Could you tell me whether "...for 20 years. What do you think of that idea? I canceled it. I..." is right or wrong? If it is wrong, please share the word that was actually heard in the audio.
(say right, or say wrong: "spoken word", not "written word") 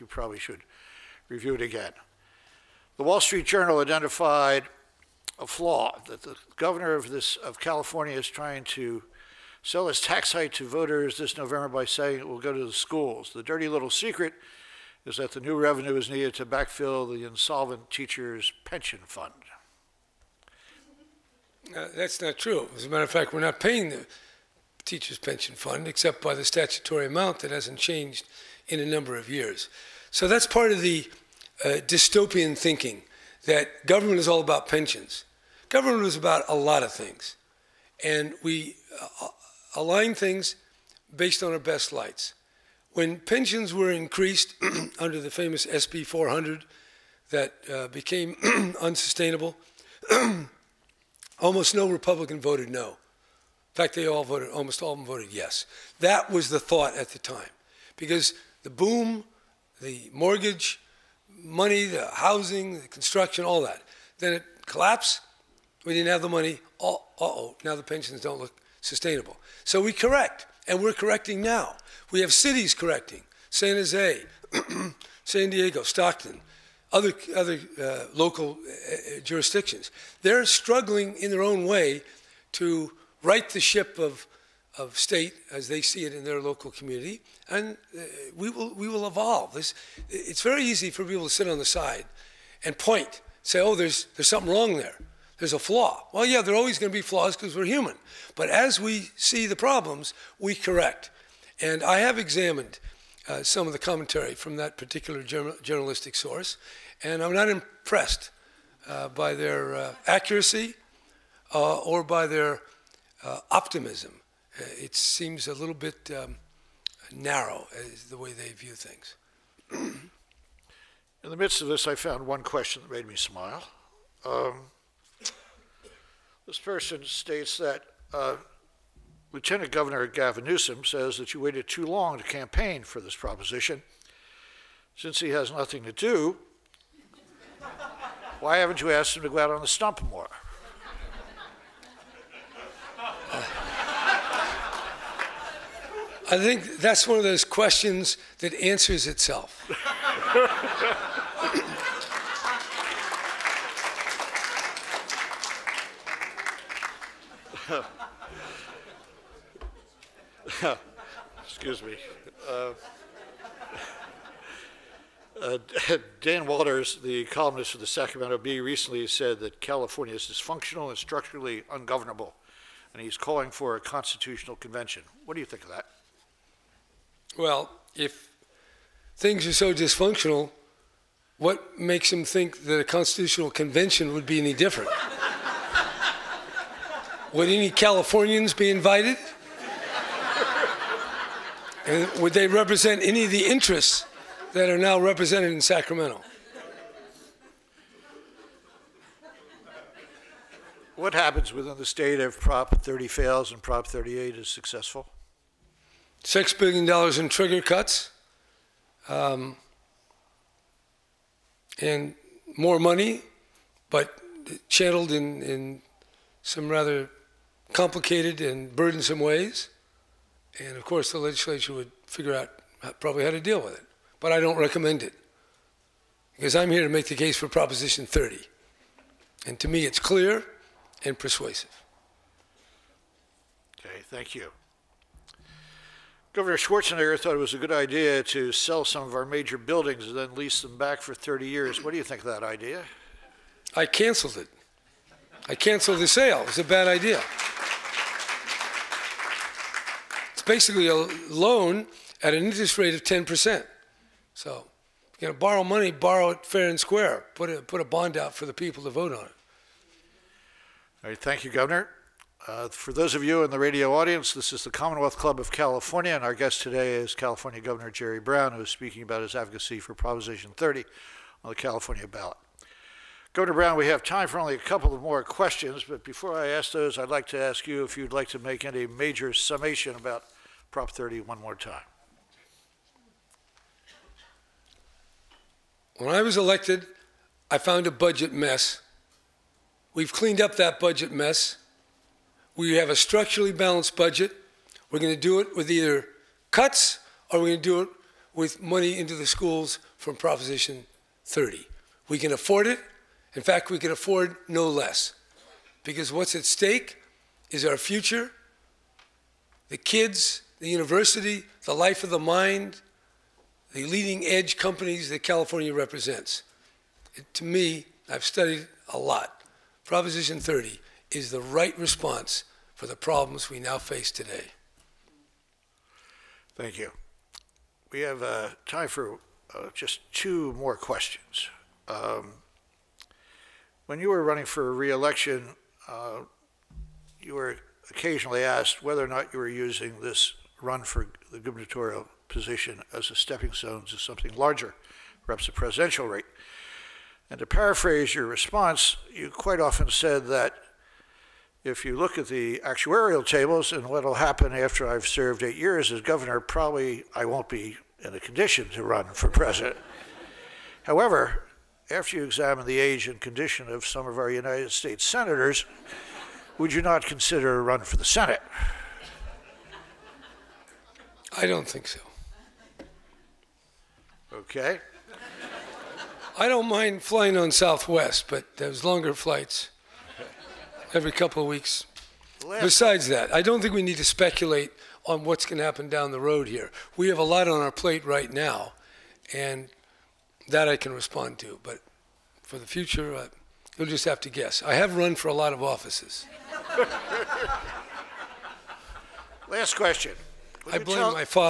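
wrong: "30", not "20".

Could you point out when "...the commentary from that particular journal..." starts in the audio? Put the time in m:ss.
1:43.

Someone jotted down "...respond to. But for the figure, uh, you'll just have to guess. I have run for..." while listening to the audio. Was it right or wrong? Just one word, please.
wrong.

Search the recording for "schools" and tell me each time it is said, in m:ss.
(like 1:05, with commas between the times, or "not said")
0:12, 4:59.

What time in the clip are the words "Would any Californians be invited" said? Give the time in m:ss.
3:07.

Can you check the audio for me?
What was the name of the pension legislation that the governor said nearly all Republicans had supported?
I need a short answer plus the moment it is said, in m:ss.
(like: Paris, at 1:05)
SB 400, at 0:45.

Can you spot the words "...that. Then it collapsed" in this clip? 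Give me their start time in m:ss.
1:03.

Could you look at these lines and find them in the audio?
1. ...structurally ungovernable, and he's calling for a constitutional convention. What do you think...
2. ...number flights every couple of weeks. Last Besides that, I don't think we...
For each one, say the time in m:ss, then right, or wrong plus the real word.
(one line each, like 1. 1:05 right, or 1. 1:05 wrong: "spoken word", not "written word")
1. 2:50 right
2. 6:18 wrong: "longer", not "number".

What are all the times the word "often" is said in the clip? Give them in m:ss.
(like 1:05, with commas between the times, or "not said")
5:49.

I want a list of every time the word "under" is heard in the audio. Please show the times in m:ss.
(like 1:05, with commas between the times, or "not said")
0:44.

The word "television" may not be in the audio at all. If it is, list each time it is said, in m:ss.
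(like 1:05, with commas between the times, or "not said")
not said.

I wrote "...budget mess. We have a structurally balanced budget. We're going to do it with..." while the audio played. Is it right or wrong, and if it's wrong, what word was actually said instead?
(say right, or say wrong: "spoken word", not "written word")
right.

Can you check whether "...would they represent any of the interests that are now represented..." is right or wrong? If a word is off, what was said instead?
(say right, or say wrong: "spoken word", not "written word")
right.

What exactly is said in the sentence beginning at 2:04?
Um, this person states that uh, Lieutenant Governor Gavin Newsom says that you waited too long to campaign for this proposition.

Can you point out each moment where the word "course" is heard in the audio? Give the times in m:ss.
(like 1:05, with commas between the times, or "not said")
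3:40.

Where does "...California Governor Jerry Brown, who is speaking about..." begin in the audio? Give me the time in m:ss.
4:27.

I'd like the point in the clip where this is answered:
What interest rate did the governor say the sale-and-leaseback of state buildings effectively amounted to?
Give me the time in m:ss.
4:13.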